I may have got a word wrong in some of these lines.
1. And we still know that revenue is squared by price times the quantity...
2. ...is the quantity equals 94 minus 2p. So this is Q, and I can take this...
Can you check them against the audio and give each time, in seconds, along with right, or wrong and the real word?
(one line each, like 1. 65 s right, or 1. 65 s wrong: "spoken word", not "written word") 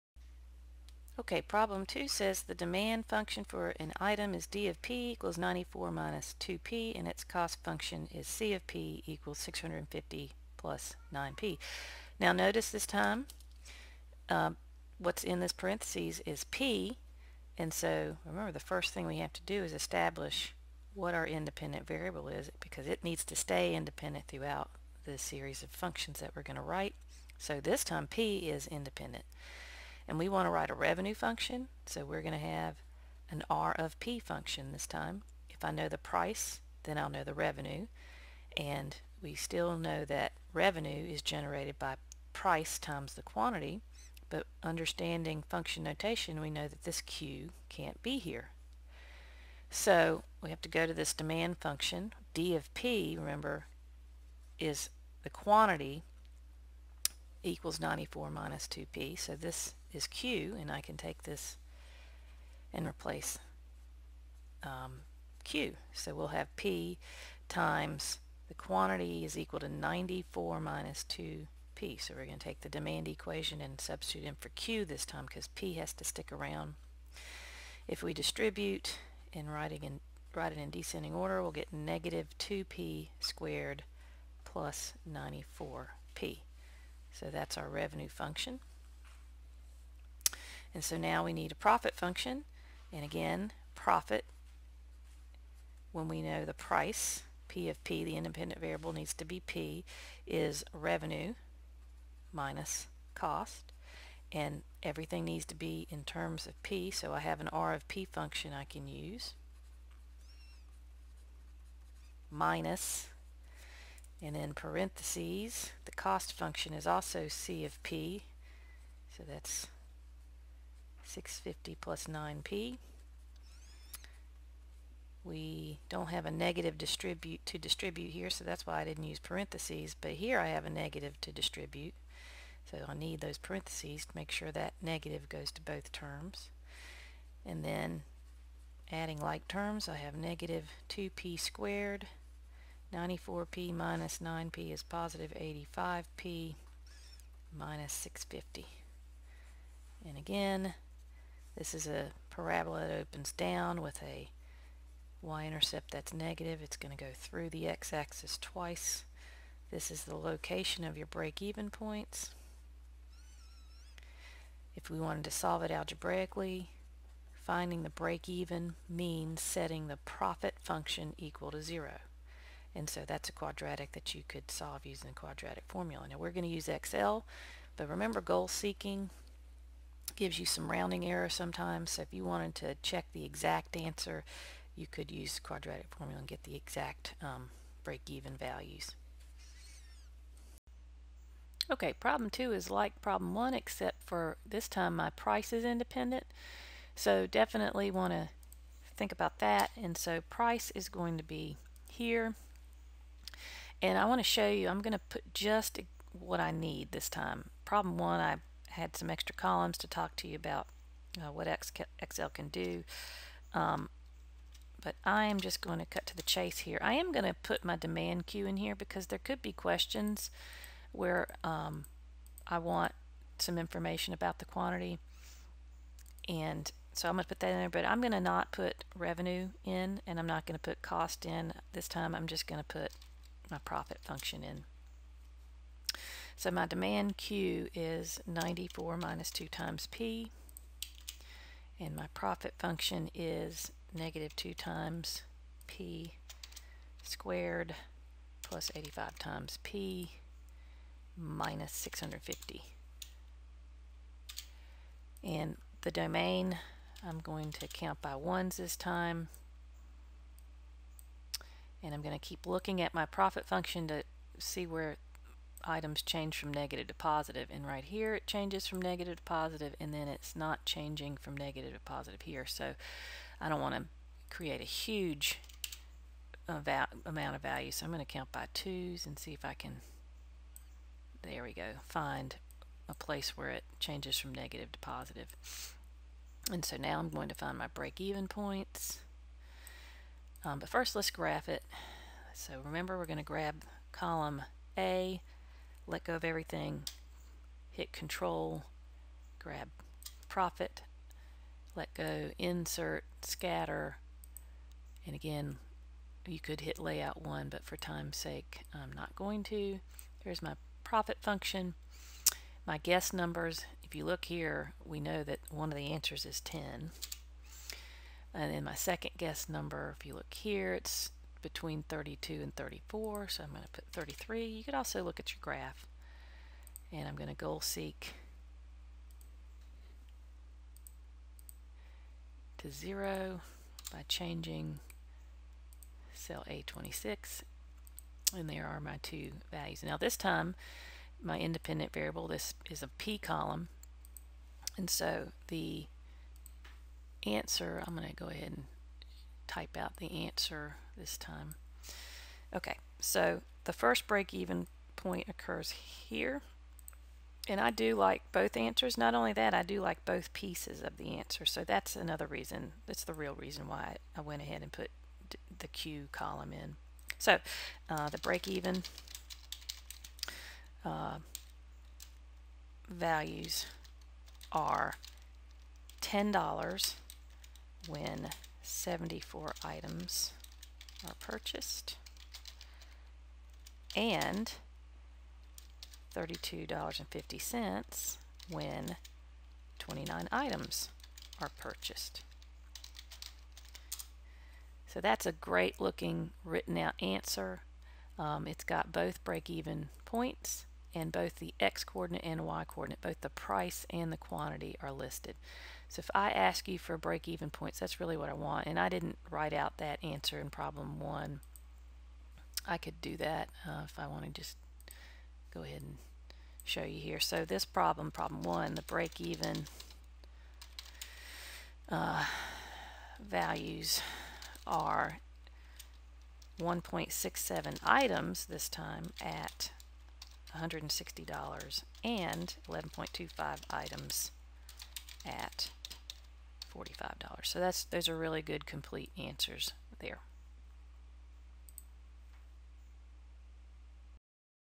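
1. 38 s wrong: "generated", not "squared"
2. 54 s right.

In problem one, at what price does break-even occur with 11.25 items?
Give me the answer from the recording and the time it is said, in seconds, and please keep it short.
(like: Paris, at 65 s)
$45, at 436 s.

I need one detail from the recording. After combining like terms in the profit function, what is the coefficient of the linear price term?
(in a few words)
85.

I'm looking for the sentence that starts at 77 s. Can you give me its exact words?
If we distribute and writing in, write it in descending order, we'll get negative 2P squared plus 94P.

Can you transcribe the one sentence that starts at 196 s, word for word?
So definitely want to think about that.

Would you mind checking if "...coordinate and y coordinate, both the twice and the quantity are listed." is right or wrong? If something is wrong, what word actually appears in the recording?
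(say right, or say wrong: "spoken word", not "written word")
wrong: "price", not "twice".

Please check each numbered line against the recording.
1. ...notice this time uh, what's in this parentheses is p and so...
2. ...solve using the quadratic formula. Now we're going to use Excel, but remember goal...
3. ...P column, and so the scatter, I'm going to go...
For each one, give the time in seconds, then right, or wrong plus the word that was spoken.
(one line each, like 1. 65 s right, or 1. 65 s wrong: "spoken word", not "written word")
1. 12 s right
2. 174 s right
3. 342 s wrong: "answer", not "scatter".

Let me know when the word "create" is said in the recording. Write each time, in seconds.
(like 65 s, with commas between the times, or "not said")
274 s.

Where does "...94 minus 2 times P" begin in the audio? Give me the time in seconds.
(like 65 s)
238 s.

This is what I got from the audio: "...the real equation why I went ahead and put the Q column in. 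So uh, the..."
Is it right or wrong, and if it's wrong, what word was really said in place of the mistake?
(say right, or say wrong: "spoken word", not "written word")
wrong: "reason", not "equation".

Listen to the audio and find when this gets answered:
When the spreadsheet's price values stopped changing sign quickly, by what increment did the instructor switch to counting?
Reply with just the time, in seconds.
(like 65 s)
278 s.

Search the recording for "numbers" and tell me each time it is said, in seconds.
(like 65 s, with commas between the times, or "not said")
313 s, 319 s.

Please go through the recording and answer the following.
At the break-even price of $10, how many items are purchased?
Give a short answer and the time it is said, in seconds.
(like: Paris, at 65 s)
74, at 378 s.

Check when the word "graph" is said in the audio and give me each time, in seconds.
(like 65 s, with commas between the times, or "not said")
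291 s, 325 s.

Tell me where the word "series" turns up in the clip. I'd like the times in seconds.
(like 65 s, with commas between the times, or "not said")
25 s.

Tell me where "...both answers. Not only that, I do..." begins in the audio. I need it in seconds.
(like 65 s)
358 s.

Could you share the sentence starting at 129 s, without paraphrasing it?
But here I have a negative to distribute.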